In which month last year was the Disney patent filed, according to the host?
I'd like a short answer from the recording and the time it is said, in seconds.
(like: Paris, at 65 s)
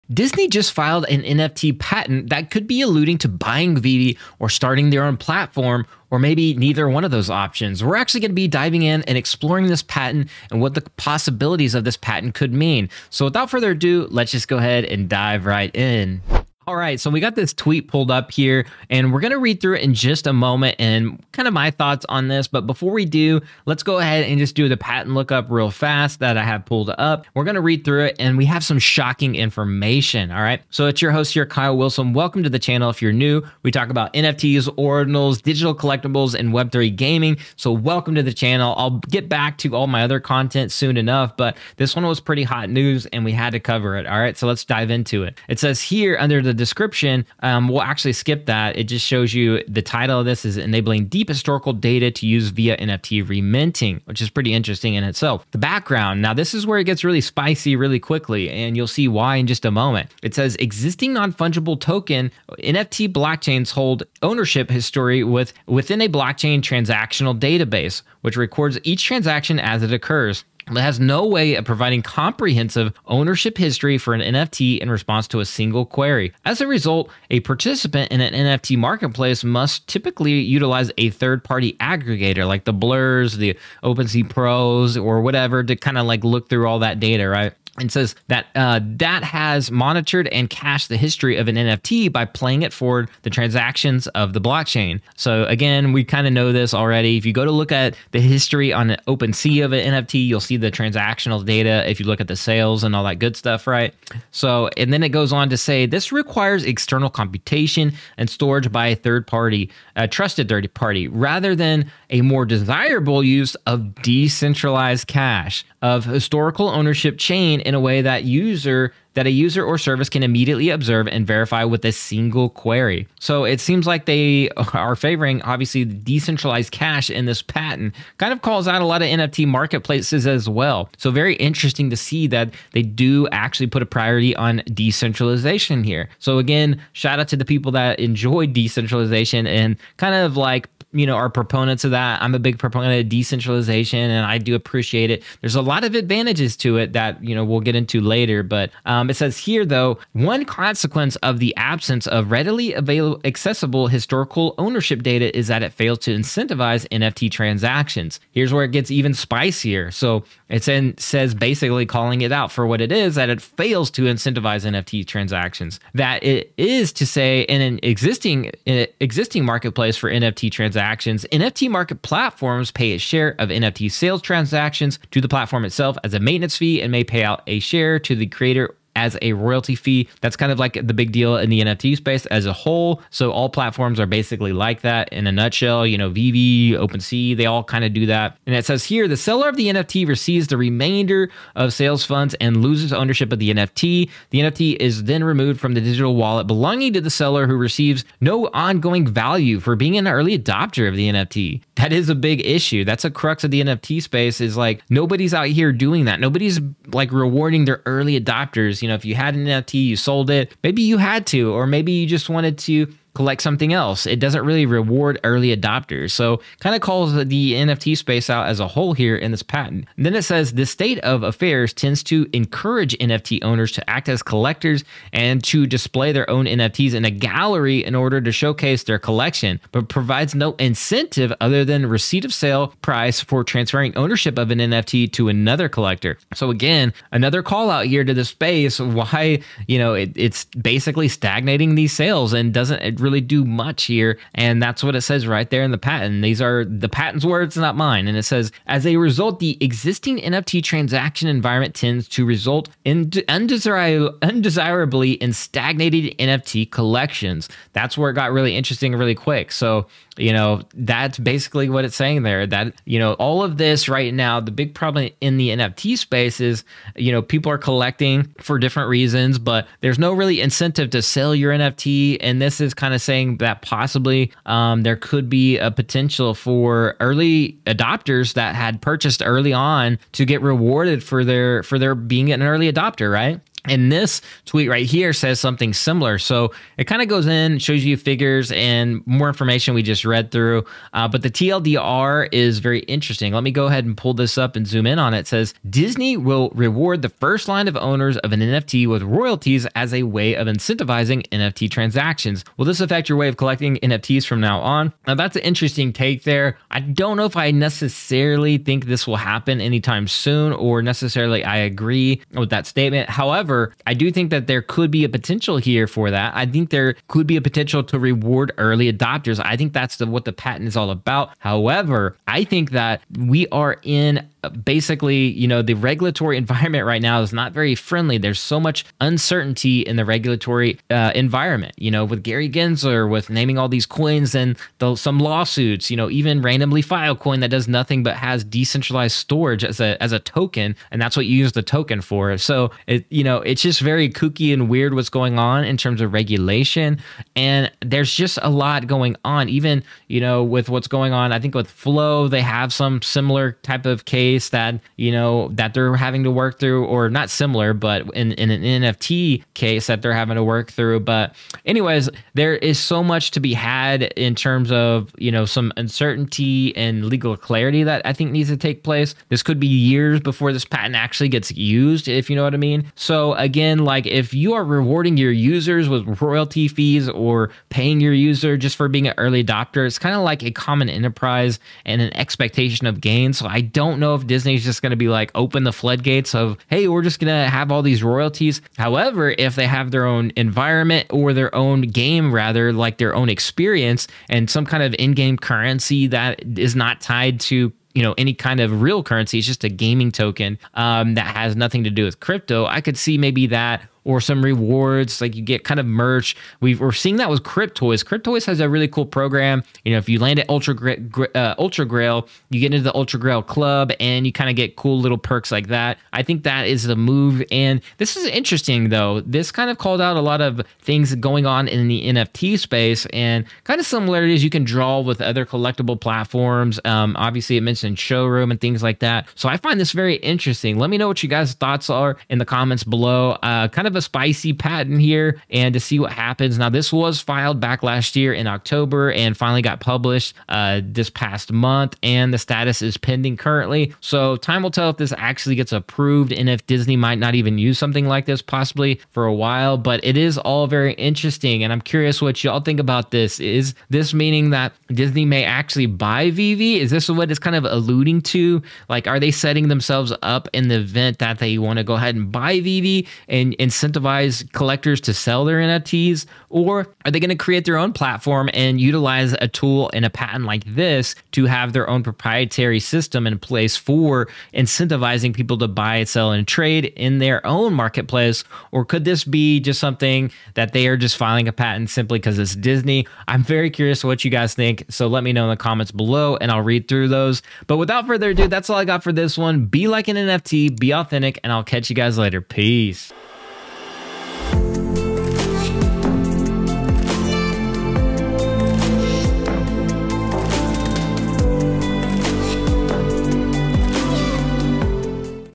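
October, at 438 s.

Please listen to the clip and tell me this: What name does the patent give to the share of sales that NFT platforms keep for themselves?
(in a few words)
maintenance fee.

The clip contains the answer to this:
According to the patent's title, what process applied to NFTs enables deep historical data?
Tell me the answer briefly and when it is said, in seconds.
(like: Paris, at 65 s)
NFT reminting, at 52 s.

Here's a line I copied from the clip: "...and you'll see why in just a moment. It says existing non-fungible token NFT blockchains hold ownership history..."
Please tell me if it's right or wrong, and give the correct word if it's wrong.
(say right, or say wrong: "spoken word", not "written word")
right.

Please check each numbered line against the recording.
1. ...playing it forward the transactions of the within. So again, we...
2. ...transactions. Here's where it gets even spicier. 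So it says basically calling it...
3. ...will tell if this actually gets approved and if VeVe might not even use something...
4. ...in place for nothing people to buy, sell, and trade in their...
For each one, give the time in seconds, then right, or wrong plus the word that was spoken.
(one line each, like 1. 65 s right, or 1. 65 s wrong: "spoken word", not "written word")
1. 92 s wrong: "blockchain", not "within"
2. 157 s right
3. 444 s wrong: "Disney", not "VeVe"
4. 473 s wrong: "incentivizing", not "nothing".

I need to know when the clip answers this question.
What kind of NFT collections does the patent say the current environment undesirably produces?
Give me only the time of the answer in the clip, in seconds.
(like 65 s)
255 s.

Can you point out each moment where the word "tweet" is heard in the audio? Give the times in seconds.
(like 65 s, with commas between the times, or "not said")
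17 s, 284 s.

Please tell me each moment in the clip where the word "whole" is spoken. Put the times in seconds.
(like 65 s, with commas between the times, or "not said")
182 s, 218 s.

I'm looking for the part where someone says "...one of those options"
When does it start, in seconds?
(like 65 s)
6 s.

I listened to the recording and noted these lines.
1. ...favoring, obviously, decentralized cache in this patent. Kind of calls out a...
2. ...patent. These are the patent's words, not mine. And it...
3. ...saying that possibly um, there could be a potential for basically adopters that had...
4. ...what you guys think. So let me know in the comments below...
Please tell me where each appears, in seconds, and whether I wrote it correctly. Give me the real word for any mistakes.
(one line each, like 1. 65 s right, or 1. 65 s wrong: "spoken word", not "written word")
1. 124 s right
2. 245 s right
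3. 273 s wrong: "early", not "basically"
4. 484 s right.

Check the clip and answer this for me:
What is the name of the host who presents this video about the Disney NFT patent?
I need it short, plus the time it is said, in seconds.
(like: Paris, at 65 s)
Kyle Willson, at 31 s.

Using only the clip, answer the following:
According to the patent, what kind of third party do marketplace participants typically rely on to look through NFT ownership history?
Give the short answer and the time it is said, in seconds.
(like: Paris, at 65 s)
third party aggregator, at 81 s.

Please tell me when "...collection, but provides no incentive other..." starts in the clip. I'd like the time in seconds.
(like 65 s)
228 s.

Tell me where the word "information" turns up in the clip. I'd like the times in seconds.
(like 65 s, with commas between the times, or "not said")
29 s, 289 s.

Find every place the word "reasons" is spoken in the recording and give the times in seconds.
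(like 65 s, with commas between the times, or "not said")
268 s.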